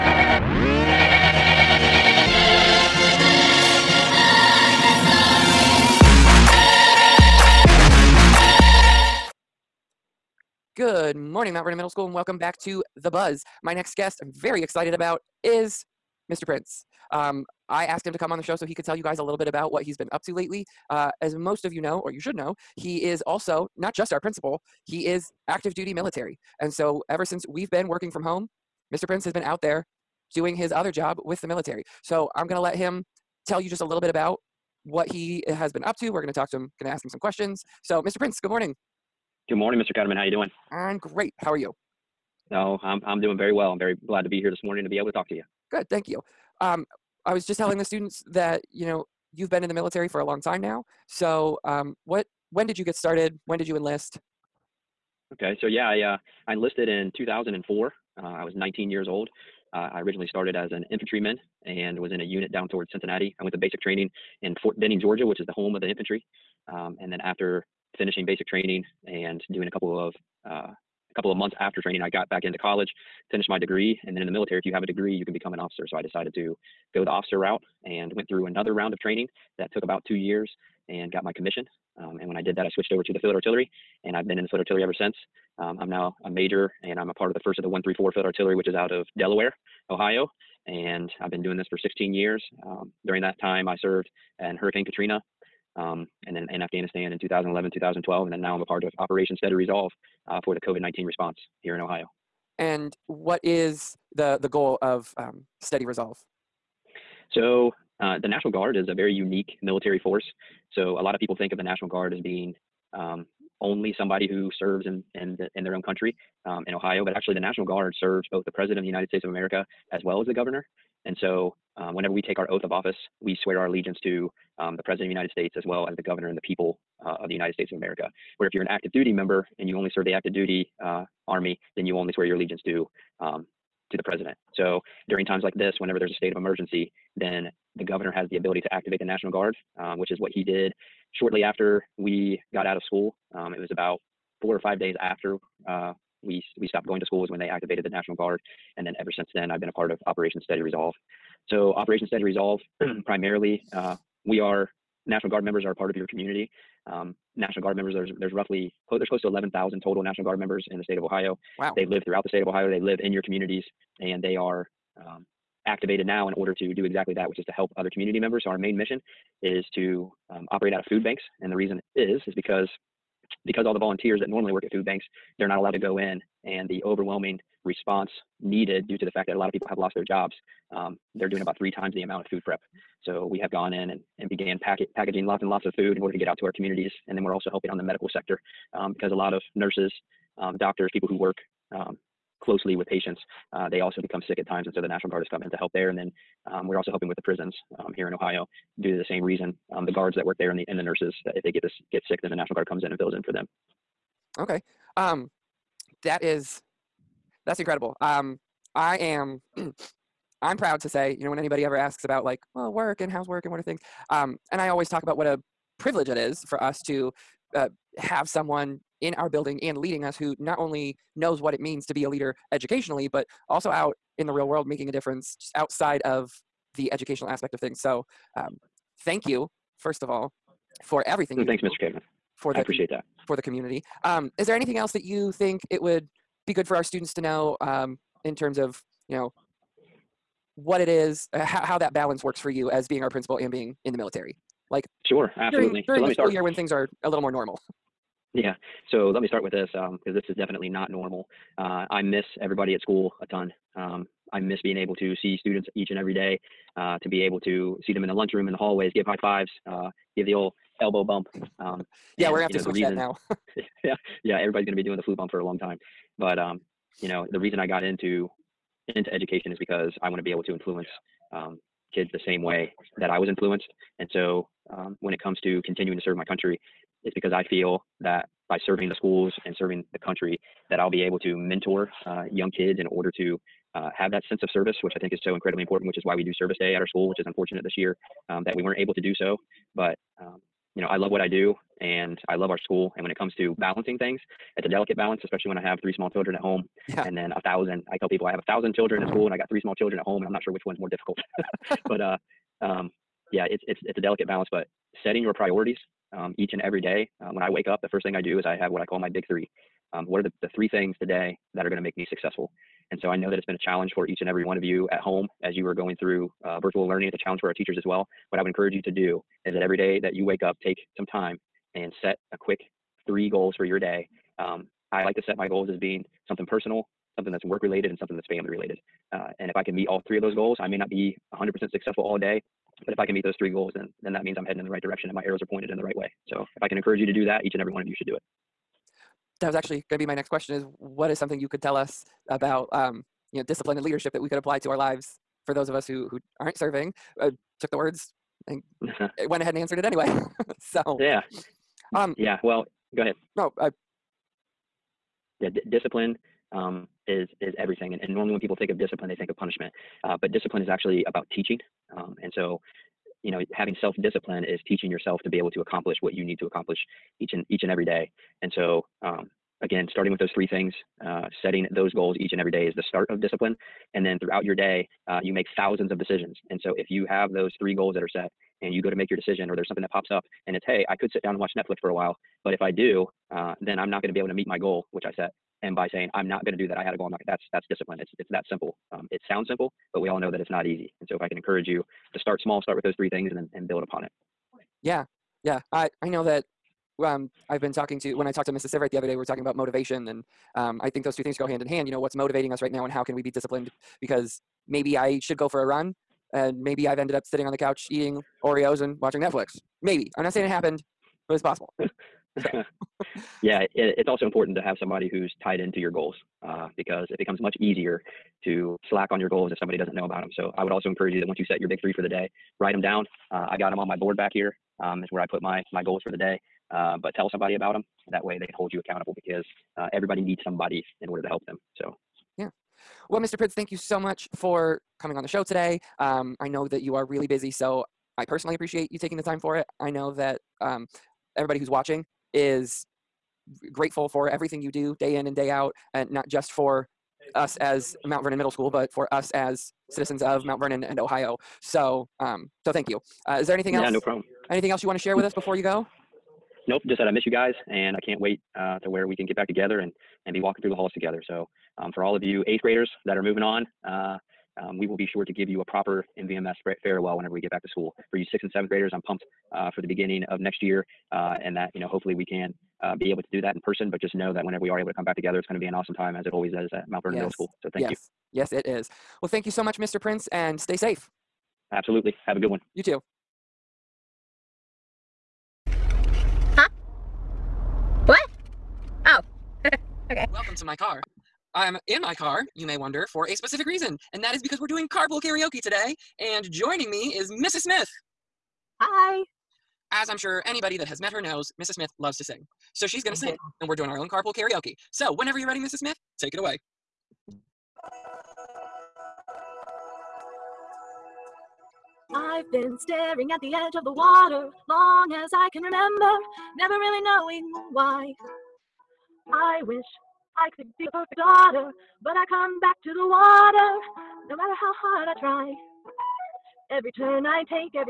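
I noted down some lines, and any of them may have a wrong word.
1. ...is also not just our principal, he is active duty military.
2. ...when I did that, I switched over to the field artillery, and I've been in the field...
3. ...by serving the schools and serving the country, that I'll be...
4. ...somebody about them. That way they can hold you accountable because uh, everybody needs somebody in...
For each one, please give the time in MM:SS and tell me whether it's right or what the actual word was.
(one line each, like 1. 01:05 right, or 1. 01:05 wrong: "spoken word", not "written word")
1. 00:23 right
2. 01:22 right
3. 04:38 right
4. 07:07 right.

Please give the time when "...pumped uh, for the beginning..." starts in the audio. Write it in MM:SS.
07:49.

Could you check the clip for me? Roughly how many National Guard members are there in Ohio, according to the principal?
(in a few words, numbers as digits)
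11,000.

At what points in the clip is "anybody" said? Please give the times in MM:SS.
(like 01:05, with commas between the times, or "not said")
03:31, 08:20.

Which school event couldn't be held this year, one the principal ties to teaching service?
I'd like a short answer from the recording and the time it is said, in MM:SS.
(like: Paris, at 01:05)
Service Day, at 04:46.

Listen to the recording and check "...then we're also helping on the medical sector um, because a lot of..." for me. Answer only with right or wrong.
right.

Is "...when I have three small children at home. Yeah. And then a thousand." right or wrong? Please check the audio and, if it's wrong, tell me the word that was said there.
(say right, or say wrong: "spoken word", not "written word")
right.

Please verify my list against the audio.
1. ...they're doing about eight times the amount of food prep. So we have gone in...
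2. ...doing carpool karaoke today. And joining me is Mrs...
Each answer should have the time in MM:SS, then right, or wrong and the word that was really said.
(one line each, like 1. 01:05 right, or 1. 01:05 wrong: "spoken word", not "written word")
1. 03:01 wrong: "three", not "eight"
2. 08:14 right.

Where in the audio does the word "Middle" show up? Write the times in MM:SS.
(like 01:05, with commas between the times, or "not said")
00:11, 07:28, 07:57.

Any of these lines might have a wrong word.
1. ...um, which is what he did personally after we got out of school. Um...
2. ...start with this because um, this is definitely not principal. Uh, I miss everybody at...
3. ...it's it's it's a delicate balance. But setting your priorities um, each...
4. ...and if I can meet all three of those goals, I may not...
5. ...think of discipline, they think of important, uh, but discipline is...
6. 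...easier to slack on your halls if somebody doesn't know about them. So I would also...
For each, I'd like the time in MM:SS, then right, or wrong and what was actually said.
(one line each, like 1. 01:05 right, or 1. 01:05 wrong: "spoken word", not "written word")
1. 02:19 wrong: "shortly", not "personally"
2. 04:09 wrong: "normal", not "principal"
3. 05:03 right
4. 05:29 right
5. 05:58 wrong: "punishment", not "important"
6. 06:57 wrong: "goals", not "halls".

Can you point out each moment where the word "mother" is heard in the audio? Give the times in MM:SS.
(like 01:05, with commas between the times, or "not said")
not said.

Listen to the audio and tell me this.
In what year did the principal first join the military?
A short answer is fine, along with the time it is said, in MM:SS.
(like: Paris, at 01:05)
2004, at 00:57.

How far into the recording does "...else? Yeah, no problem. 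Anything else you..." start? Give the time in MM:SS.
07:33.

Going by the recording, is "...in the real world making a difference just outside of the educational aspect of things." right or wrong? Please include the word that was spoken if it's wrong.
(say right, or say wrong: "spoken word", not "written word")
right.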